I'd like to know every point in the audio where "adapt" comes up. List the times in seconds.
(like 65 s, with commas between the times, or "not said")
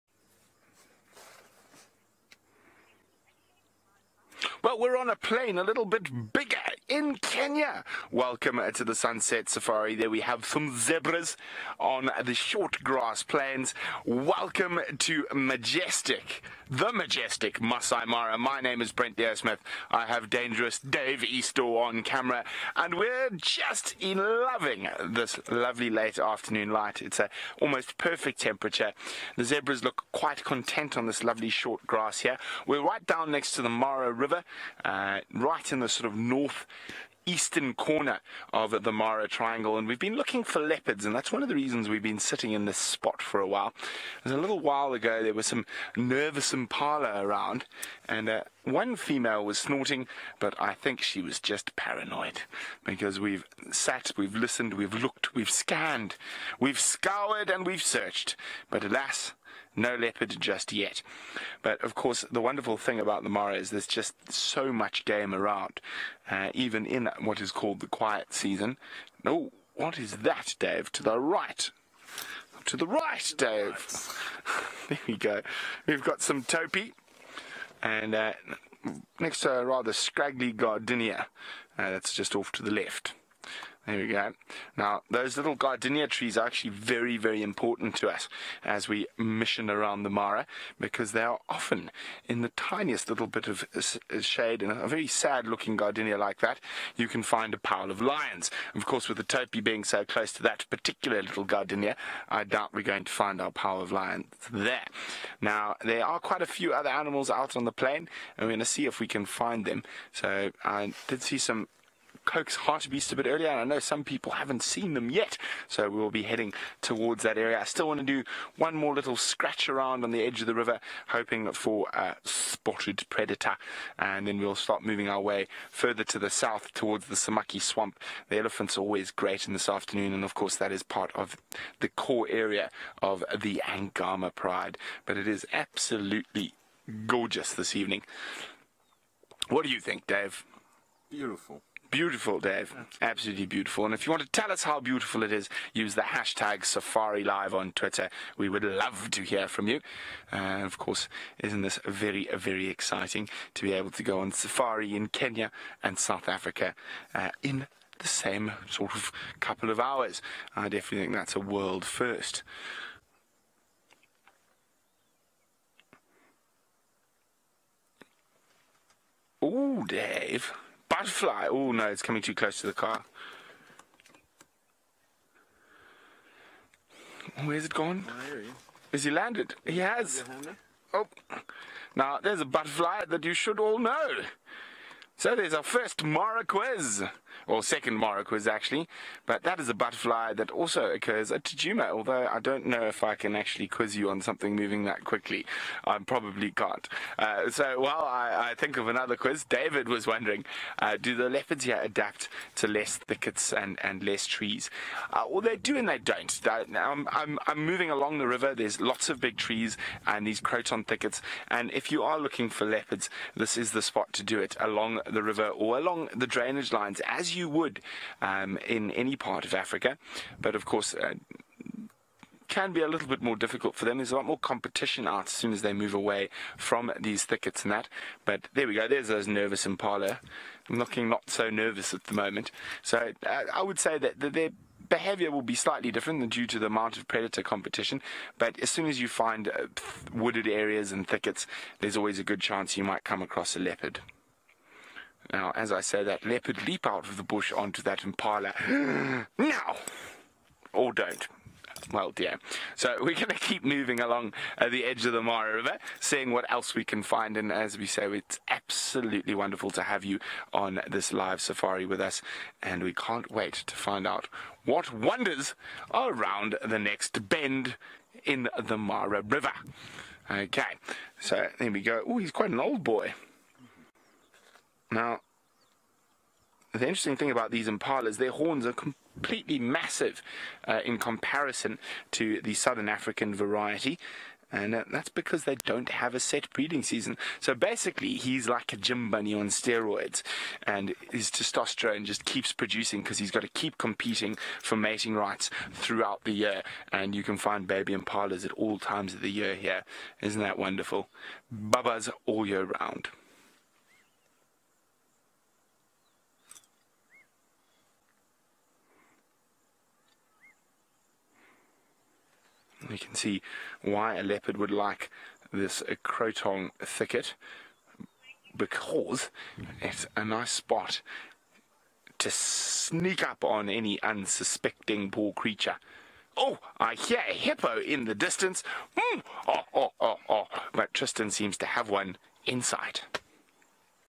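201 s.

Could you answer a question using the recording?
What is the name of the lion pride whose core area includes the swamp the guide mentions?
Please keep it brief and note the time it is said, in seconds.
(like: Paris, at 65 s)
Angama Pride, at 133 s.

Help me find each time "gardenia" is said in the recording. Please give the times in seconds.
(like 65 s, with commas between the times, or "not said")
80 s, 85 s, 95 s, 101 s.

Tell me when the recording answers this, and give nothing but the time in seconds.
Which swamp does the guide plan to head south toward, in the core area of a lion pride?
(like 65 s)
127 s.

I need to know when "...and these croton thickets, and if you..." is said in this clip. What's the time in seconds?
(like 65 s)
210 s.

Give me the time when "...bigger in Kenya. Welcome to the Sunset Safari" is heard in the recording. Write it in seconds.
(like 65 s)
6 s.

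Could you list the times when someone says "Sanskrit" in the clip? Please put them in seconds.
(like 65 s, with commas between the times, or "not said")
not said.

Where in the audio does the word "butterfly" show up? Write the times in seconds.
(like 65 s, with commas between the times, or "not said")
182 s, 189 s.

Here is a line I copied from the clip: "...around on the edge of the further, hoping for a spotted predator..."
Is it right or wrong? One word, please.
wrong.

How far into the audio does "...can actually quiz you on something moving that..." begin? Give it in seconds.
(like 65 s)
193 s.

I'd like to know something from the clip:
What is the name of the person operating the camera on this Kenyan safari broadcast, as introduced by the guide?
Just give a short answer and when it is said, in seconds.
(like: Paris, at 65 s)
Dangerous Dave Eastall, at 20 s.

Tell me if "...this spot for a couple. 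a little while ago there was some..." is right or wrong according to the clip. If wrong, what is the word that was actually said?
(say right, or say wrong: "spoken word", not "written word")
wrong: "while", not "couple".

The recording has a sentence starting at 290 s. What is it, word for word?
And his testosterone just keeps producing because he's got to keep competing for mating rights throughout the year.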